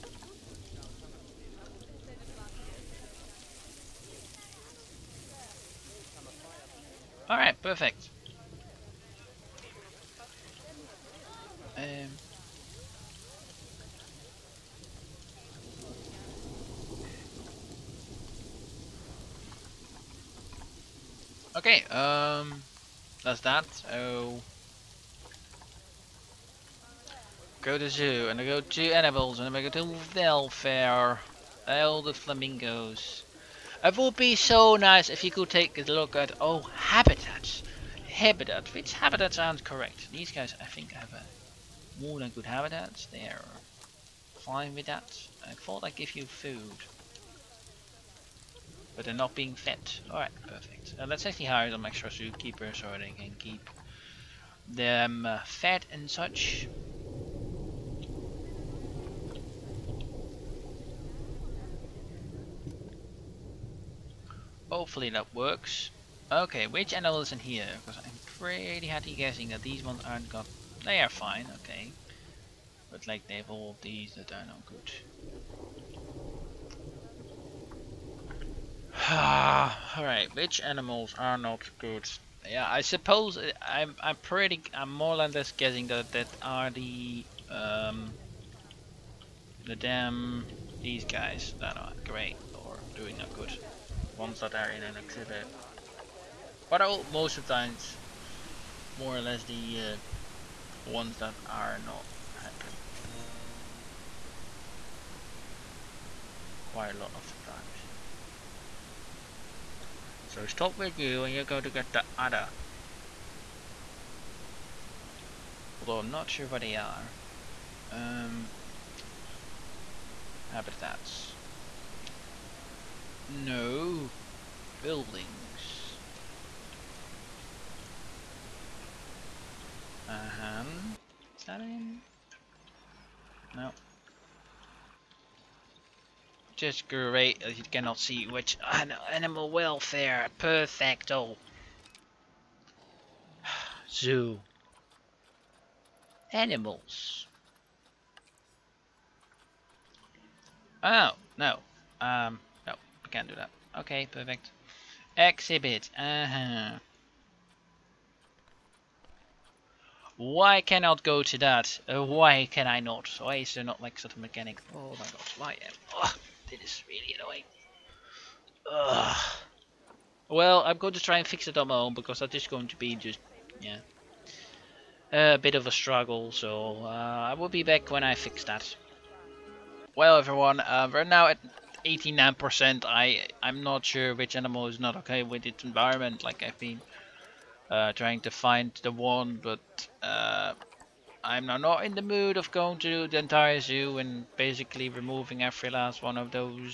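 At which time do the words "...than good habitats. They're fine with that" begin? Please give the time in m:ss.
0:42.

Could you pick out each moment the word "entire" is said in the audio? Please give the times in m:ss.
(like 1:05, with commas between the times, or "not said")
3:13.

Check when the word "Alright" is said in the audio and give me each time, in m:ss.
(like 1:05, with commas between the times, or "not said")
0:50, 1:19.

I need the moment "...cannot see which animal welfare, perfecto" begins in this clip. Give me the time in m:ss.
2:17.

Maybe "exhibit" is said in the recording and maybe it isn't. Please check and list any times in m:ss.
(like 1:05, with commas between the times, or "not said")
1:34, 2:35.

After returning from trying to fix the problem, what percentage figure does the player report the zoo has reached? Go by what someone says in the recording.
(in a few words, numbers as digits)
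89%.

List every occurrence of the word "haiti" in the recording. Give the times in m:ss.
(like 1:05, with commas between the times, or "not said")
not said.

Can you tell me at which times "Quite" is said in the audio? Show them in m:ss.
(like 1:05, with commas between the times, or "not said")
1:46.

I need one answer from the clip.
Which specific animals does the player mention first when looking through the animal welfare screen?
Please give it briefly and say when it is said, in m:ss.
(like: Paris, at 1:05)
Flamingos, at 0:32.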